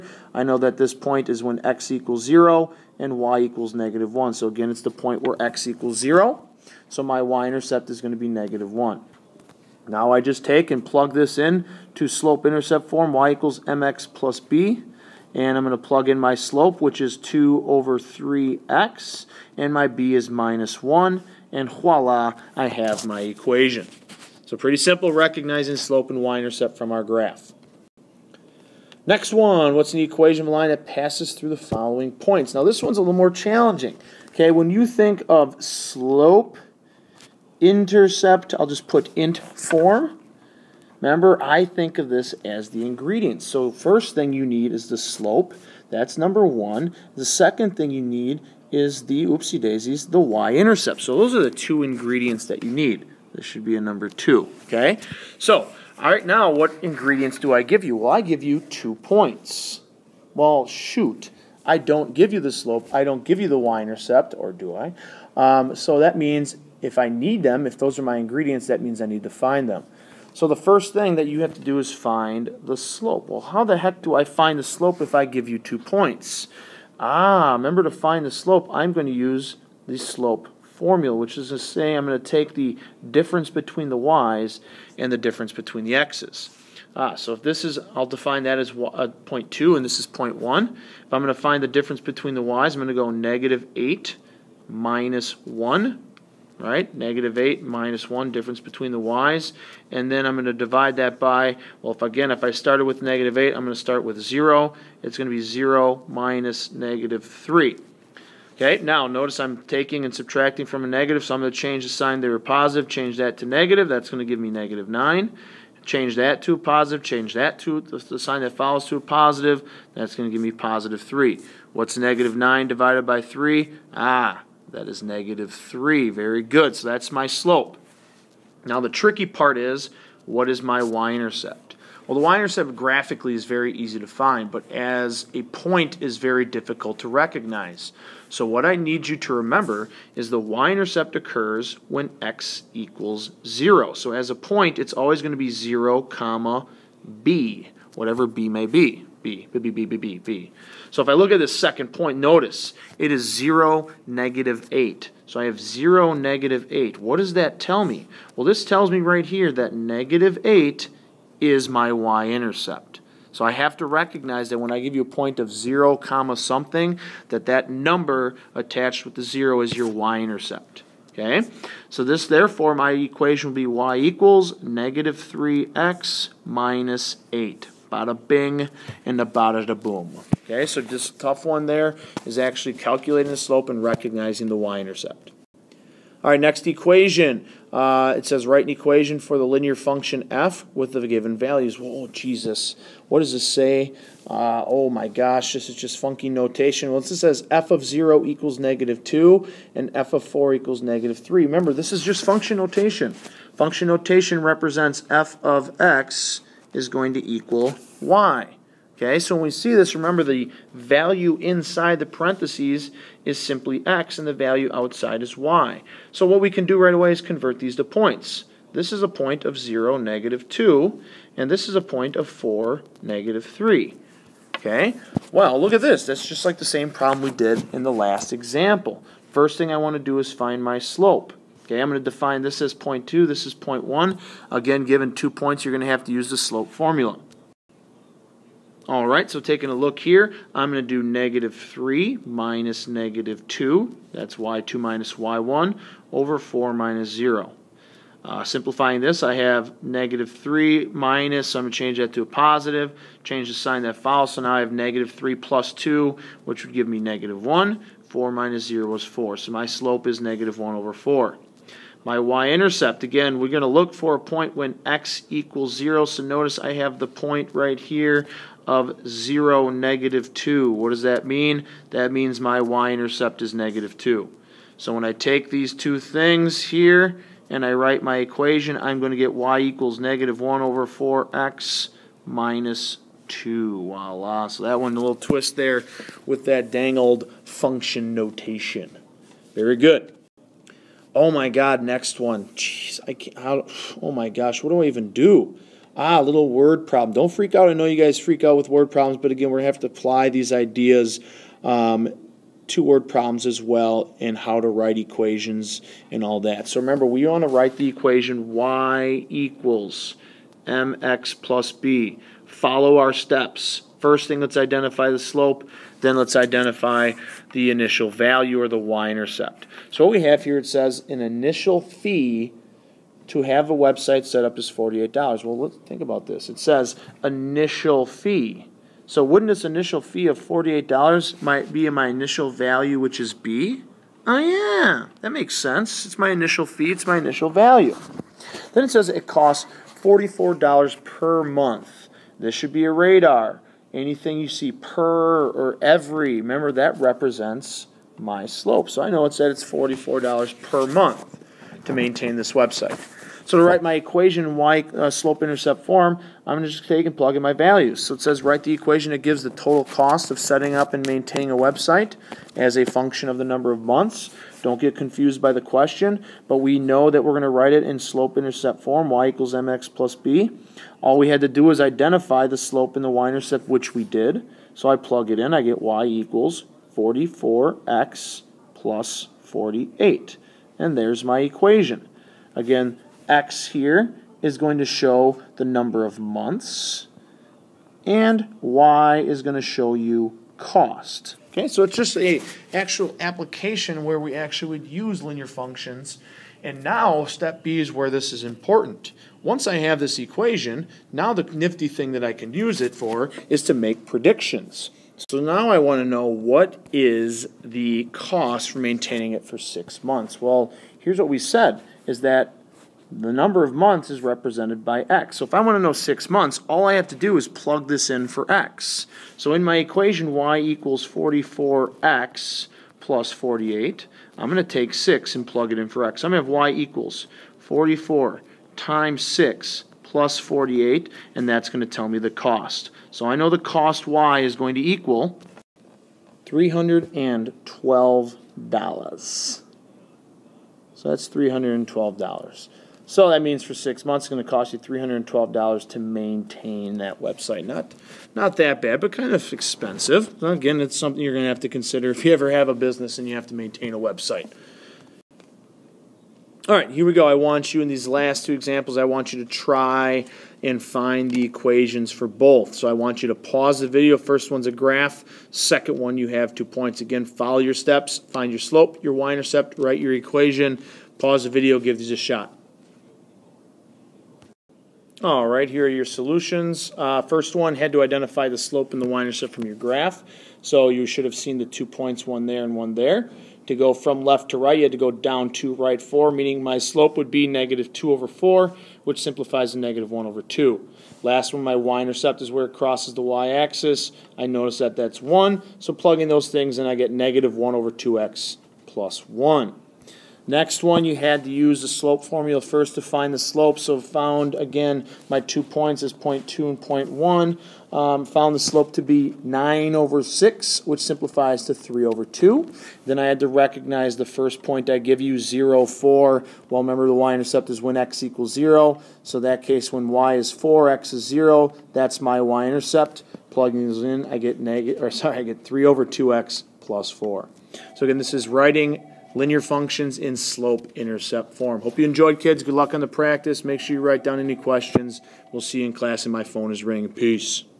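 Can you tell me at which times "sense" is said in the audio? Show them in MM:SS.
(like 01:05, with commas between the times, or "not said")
05:35.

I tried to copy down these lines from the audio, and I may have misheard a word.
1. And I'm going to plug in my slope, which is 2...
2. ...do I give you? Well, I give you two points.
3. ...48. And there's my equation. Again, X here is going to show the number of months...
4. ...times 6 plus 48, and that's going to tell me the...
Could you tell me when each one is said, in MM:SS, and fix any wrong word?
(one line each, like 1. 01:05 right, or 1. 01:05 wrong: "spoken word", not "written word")
1. 00:15 right
2. 00:57 right
3. 06:19 right
4. 07:08 right.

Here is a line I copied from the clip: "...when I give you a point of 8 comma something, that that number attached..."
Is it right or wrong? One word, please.
wrong.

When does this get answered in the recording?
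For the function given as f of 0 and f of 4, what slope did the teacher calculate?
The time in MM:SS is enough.
04:20.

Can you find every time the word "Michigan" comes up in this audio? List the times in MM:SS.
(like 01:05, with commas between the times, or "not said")
not said.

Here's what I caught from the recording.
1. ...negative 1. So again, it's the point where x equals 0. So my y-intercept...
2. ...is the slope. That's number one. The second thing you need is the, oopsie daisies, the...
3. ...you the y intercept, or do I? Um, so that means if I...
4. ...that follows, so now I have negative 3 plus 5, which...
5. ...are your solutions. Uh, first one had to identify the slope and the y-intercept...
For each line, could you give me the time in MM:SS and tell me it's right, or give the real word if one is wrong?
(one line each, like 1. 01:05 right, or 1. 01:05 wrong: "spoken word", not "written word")
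1. 00:03 right
2. 00:44 right
3. 01:03 right
4. 04:13 wrong: "2", not "5"
5. 07:55 right.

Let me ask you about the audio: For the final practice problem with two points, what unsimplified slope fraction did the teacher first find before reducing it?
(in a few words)
9/6.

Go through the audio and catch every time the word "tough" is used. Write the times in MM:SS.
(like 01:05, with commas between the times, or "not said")
03:01.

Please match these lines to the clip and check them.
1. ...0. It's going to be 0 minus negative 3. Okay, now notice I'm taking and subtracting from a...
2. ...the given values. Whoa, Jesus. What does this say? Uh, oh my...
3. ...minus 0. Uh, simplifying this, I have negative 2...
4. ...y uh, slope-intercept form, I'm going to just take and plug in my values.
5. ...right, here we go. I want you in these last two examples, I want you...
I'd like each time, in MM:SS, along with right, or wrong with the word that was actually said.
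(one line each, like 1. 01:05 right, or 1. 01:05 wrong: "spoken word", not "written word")
1. 01:44 right
2. 03:10 right
3. 04:06 wrong: "3", not "2"
4. 05:54 right
5. 07:36 right.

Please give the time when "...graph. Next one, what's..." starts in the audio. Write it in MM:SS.
00:27.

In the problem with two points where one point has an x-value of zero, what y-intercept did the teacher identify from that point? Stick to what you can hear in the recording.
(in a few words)
-8.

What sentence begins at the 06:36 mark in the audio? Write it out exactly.
And now step B is where this is important.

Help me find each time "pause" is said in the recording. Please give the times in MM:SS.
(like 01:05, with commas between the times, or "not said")
07:43, 07:51.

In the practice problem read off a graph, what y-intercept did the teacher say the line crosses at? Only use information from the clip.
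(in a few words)
1.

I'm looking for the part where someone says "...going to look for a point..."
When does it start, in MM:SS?
04:23.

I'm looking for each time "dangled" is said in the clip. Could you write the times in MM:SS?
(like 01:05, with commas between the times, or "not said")
04:46.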